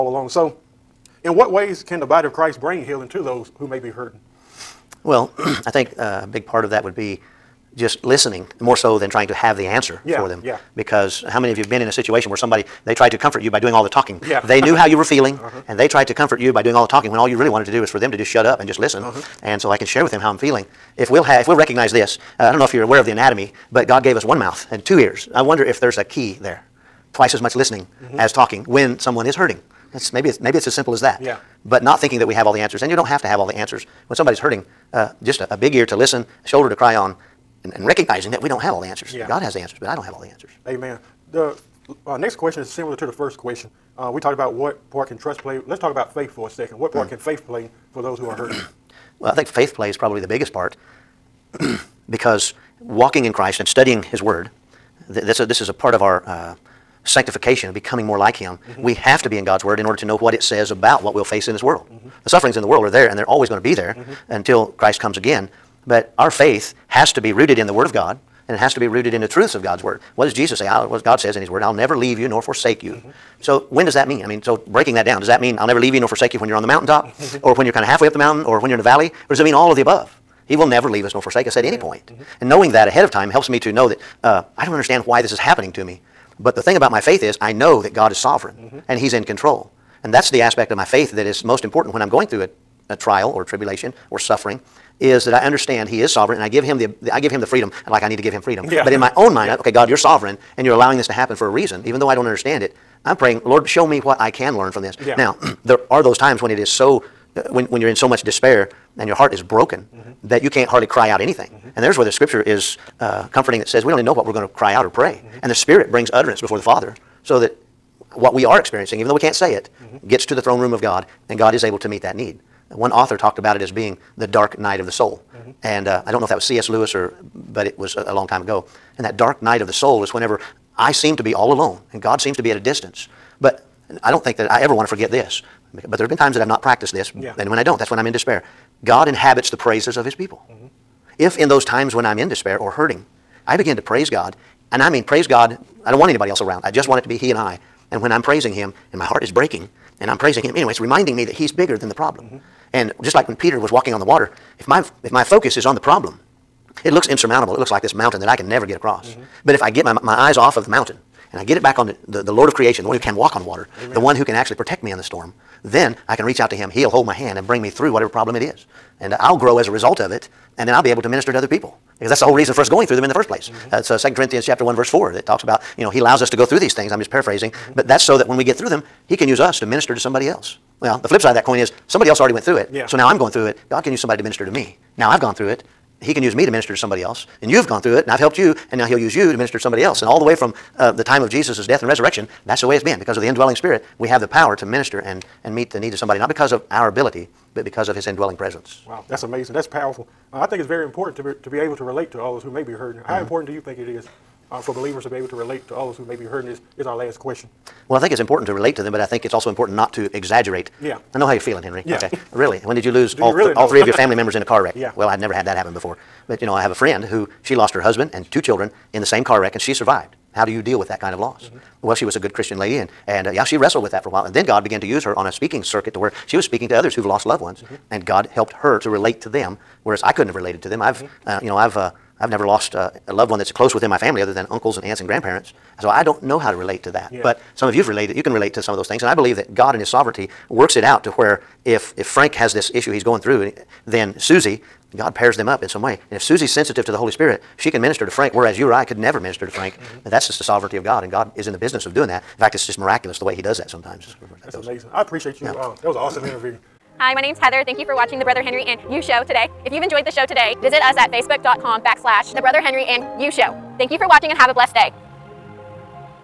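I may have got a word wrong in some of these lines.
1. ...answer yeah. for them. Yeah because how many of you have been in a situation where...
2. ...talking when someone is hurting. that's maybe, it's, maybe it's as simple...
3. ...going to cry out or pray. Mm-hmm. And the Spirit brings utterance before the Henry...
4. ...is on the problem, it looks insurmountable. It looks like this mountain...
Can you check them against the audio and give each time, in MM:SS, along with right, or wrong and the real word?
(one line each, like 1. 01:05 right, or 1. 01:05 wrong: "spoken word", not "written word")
1. 00:09 right
2. 00:28 right
3. 01:54 wrong: "Father", not "Henry"
4. 02:35 right.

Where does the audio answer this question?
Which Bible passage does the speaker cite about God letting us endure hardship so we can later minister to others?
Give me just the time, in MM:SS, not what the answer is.
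02:53.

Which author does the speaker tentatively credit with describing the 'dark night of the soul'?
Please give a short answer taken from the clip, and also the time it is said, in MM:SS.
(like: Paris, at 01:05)
C.S. Lewis, at 02:06.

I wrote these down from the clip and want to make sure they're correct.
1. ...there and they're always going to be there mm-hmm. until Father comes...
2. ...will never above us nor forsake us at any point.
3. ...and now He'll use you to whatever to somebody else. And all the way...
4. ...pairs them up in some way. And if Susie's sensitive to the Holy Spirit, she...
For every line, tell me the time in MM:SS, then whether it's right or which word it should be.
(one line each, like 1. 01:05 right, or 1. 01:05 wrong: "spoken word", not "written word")
1. 01:02 wrong: "Christ", not "Father"
2. 01:20 wrong: "leave", not "above"
3. 03:08 wrong: "minister", not "whatever"
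4. 04:05 right.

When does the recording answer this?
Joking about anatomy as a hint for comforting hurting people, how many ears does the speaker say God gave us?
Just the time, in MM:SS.
00:24.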